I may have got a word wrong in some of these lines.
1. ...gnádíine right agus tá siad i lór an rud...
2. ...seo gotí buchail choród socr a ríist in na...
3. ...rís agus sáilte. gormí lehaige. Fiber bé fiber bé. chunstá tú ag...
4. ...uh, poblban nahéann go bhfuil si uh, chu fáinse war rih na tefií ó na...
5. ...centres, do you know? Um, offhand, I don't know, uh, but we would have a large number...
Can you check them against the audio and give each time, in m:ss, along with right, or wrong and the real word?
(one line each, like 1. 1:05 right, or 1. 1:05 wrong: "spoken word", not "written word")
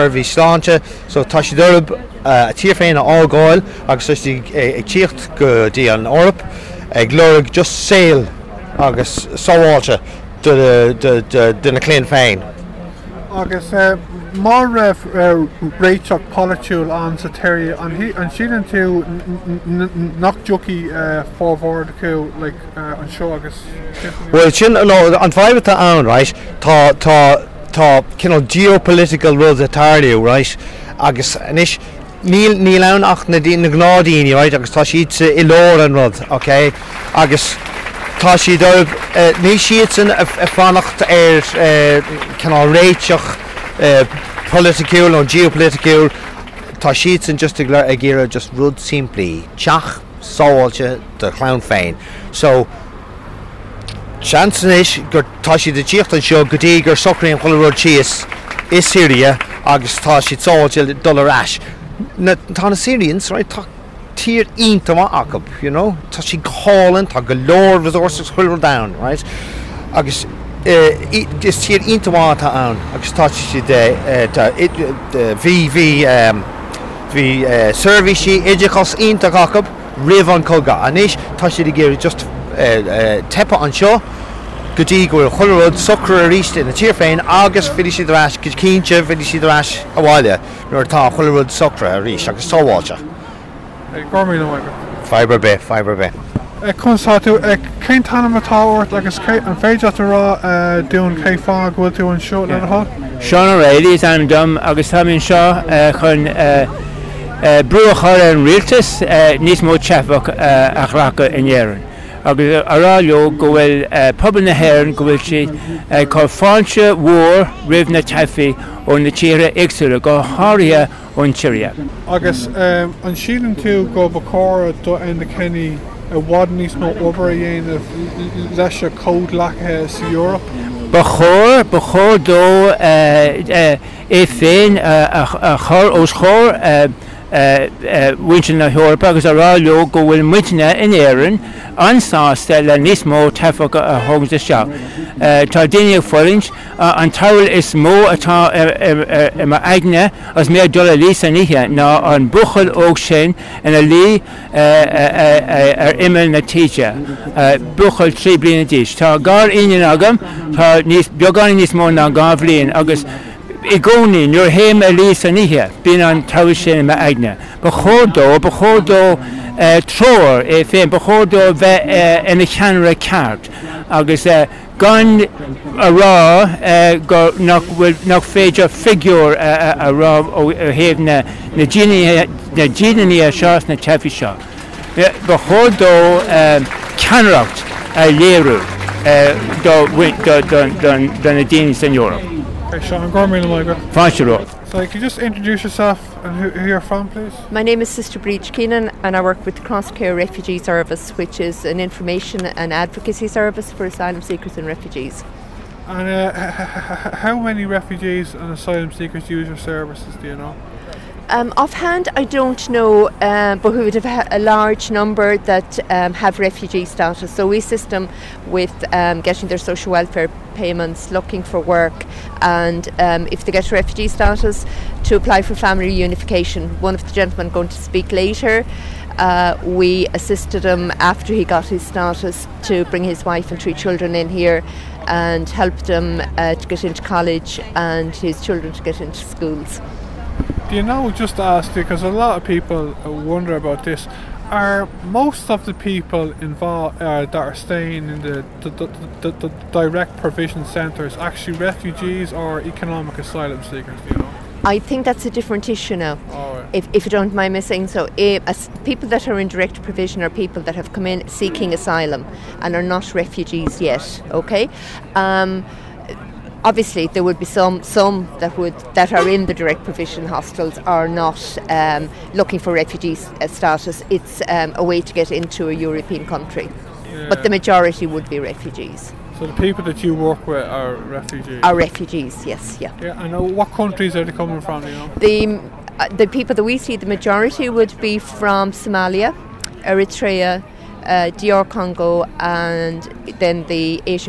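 1. 0:33 right
2. 1:23 wrong: "gofuil", not "buchail"
3. 1:32 wrong: "sáháilte", not "sáilte"
4. 1:53 right
5. 3:29 wrong: "services", not "centres".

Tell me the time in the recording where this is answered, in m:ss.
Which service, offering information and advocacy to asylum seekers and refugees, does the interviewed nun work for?
3:19.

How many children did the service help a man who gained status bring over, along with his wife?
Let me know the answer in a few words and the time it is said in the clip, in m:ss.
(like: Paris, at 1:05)
3, at 3:53.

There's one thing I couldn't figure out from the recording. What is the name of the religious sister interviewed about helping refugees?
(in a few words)
Sister Bríd Keenan.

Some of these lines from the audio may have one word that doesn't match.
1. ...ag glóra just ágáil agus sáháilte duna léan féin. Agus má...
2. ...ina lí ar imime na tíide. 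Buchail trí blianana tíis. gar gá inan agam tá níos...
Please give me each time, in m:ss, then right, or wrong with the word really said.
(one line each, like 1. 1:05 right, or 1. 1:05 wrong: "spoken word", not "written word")
1. 0:06 wrong: "saoil", not "ágáil"
2. 2:33 right.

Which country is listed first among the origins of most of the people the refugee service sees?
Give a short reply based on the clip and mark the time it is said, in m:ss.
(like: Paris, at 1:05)
Somalia, at 4:48.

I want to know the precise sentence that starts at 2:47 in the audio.
Bychodo, bychodo uh, tro'r e ffein, bychodo fe uh, yn y llanr y cart.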